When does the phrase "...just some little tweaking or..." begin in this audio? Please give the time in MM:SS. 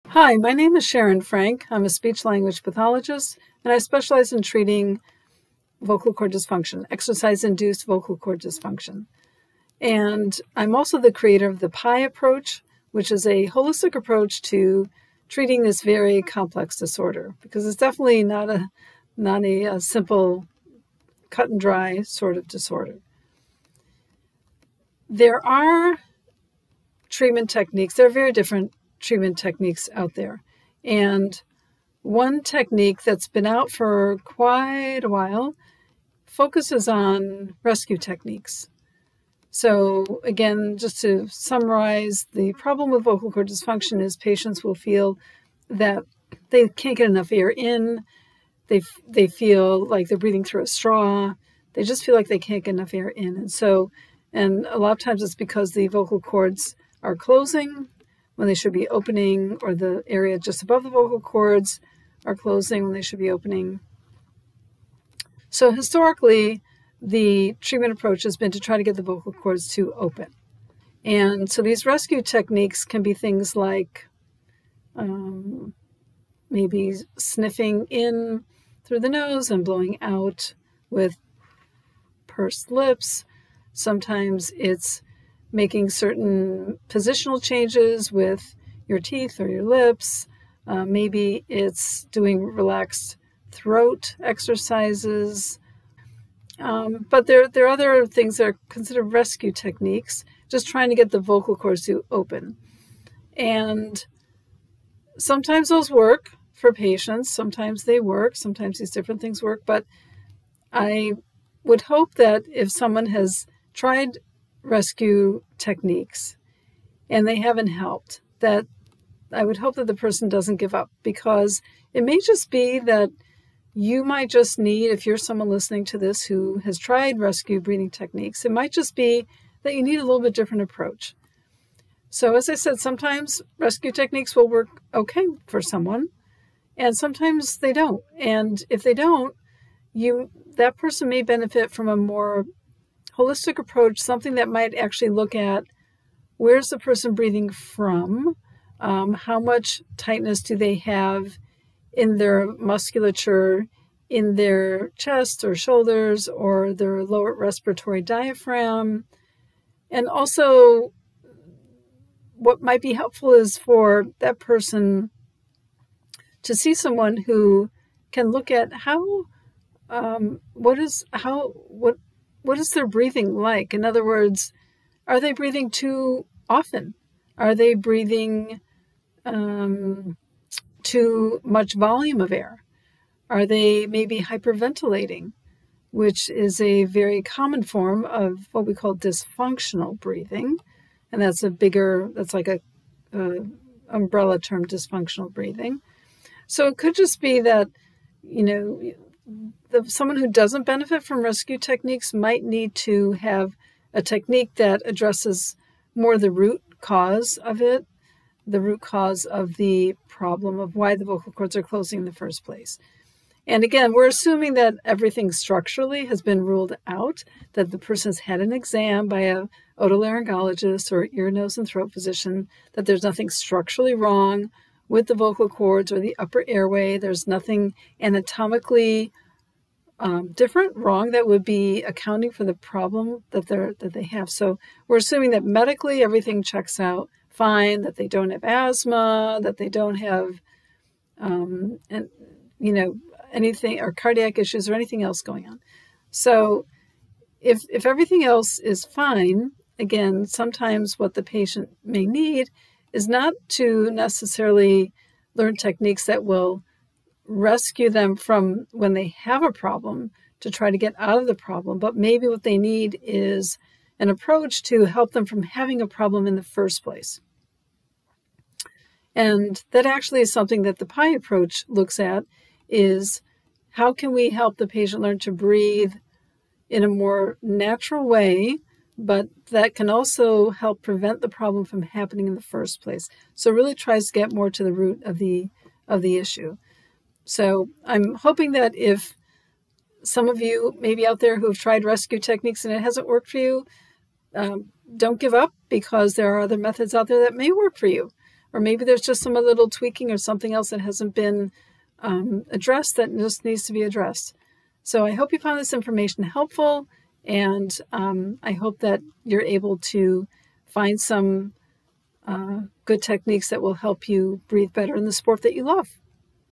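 04:59.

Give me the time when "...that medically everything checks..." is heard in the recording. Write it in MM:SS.
03:55.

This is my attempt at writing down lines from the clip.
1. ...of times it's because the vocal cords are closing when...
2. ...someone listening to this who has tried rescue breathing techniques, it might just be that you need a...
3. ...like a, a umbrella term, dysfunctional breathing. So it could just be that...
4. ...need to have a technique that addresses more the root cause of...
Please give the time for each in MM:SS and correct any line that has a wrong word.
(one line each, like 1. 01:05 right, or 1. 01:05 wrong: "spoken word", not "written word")
1. 00:54 right
2. 02:05 right
3. 03:12 right
4. 03:22 right.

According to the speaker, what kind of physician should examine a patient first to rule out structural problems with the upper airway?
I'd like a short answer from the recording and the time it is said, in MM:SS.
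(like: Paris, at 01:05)
otolaryngologist, at 03:39.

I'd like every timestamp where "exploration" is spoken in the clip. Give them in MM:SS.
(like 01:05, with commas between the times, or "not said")
not said.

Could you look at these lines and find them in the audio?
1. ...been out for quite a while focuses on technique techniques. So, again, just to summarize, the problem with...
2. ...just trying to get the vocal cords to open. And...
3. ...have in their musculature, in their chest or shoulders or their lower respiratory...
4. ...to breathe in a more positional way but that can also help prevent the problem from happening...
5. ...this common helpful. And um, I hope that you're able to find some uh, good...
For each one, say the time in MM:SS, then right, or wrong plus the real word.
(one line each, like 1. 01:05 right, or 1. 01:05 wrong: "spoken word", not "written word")
1. 00:33 wrong: "rescue", not "technique"
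2. 01:40 right
3. 02:30 right
4. 04:35 wrong: "natural", not "positional"
5. 05:05 wrong: "information", not "common".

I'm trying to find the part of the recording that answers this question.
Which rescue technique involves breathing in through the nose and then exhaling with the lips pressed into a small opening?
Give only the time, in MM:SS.
01:22.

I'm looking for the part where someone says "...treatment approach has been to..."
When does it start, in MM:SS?
01:07.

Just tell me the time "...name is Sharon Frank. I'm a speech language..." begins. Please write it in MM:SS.
00:00.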